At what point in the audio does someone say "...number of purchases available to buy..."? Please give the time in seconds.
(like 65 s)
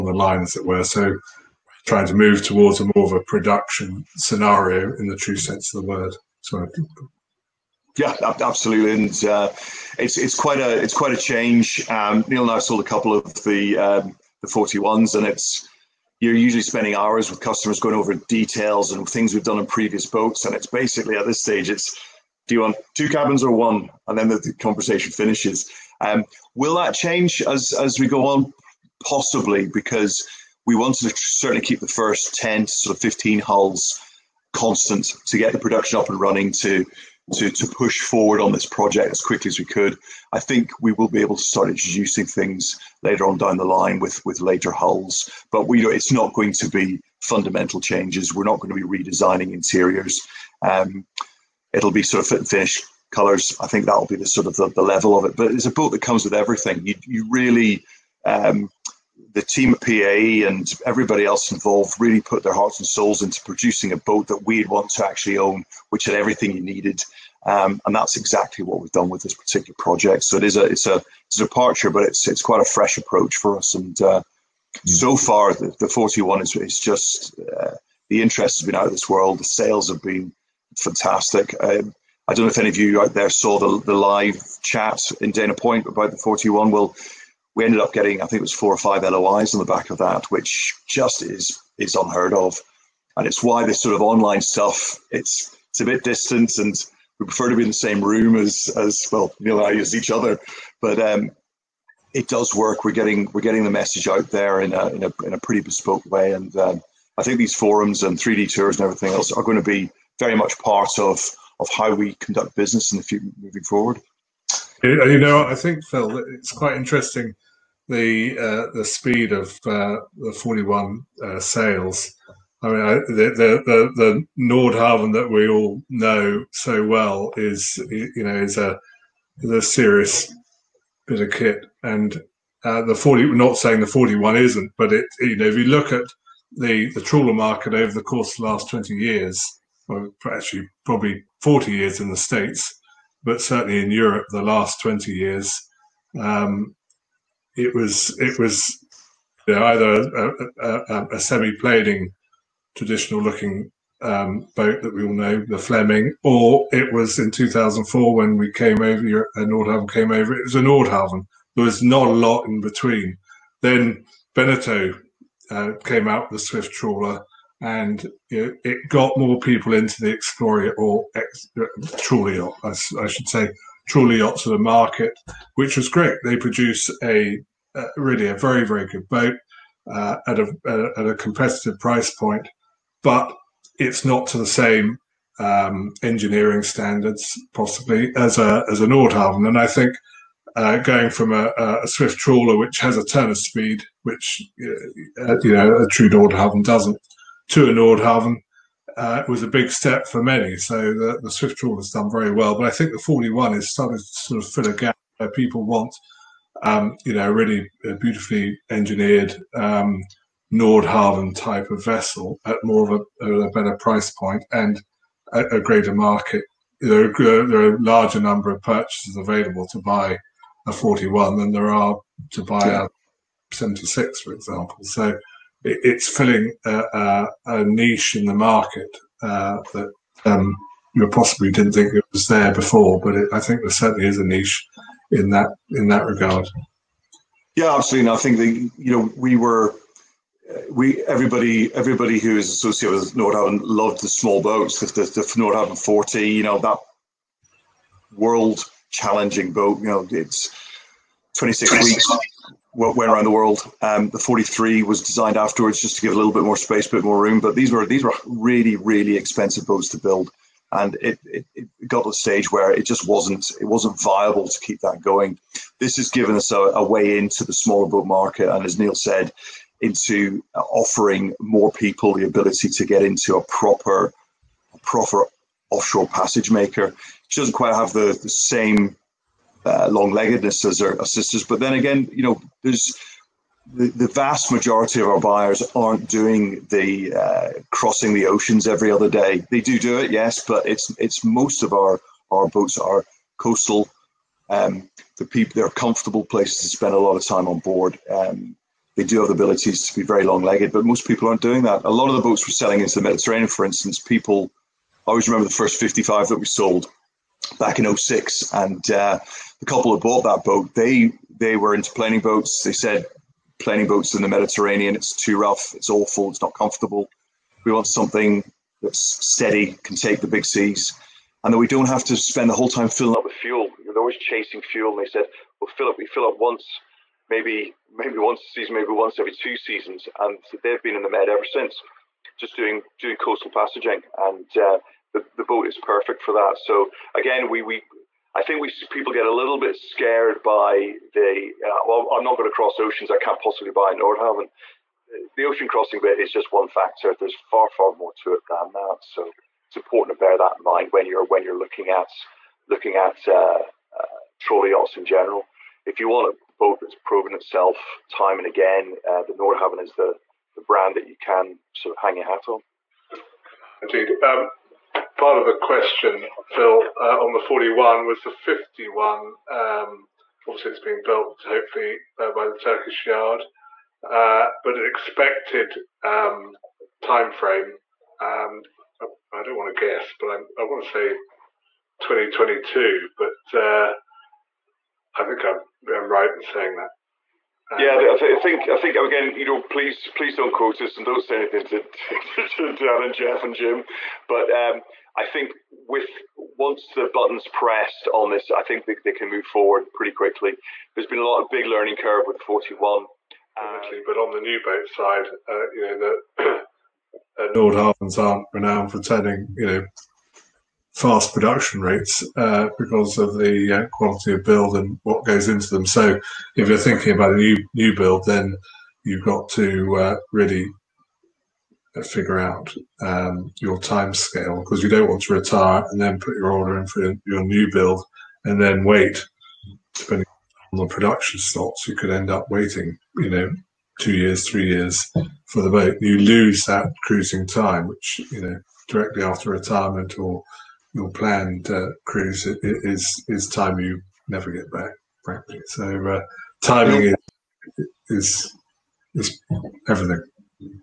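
218 s.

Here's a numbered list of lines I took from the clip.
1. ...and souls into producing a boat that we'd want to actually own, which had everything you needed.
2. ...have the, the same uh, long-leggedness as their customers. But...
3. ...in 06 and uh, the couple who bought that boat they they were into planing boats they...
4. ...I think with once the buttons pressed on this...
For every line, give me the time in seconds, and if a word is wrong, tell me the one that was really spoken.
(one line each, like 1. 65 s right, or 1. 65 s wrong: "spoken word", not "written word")
1. 62 s right
2. 277 s wrong: "sisters", not "customers"
3. 307 s right
4. 395 s right.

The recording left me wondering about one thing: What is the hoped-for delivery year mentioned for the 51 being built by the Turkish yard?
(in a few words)
2022.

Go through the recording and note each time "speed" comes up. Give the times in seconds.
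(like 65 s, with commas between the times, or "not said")
118 s, 193 s.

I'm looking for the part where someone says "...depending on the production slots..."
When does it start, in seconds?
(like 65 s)
429 s.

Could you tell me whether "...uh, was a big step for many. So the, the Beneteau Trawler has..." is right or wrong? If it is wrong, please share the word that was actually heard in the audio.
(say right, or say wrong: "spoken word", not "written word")
wrong: "Swift", not "Beneteau".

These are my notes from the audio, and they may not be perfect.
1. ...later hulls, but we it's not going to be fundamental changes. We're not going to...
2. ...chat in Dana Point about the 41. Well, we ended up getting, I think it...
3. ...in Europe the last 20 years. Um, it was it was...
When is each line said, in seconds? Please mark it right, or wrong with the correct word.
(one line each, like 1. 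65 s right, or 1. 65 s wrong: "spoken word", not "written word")
1. 44 s right
2. 84 s right
3. 143 s right.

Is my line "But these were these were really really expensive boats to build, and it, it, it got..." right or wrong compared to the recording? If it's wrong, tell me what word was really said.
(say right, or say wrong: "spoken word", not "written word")
right.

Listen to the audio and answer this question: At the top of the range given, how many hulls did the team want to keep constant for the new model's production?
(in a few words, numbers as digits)
15.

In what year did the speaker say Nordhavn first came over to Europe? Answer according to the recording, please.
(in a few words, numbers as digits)
2004.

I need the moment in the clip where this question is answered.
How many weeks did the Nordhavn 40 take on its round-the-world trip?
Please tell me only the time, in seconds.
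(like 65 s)
251 s.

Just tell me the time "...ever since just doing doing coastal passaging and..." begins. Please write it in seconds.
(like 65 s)
331 s.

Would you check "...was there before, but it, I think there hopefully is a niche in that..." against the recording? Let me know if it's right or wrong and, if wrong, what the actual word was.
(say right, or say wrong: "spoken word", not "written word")
wrong: "certainly", not "hopefully".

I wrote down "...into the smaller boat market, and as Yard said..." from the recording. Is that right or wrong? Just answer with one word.
wrong.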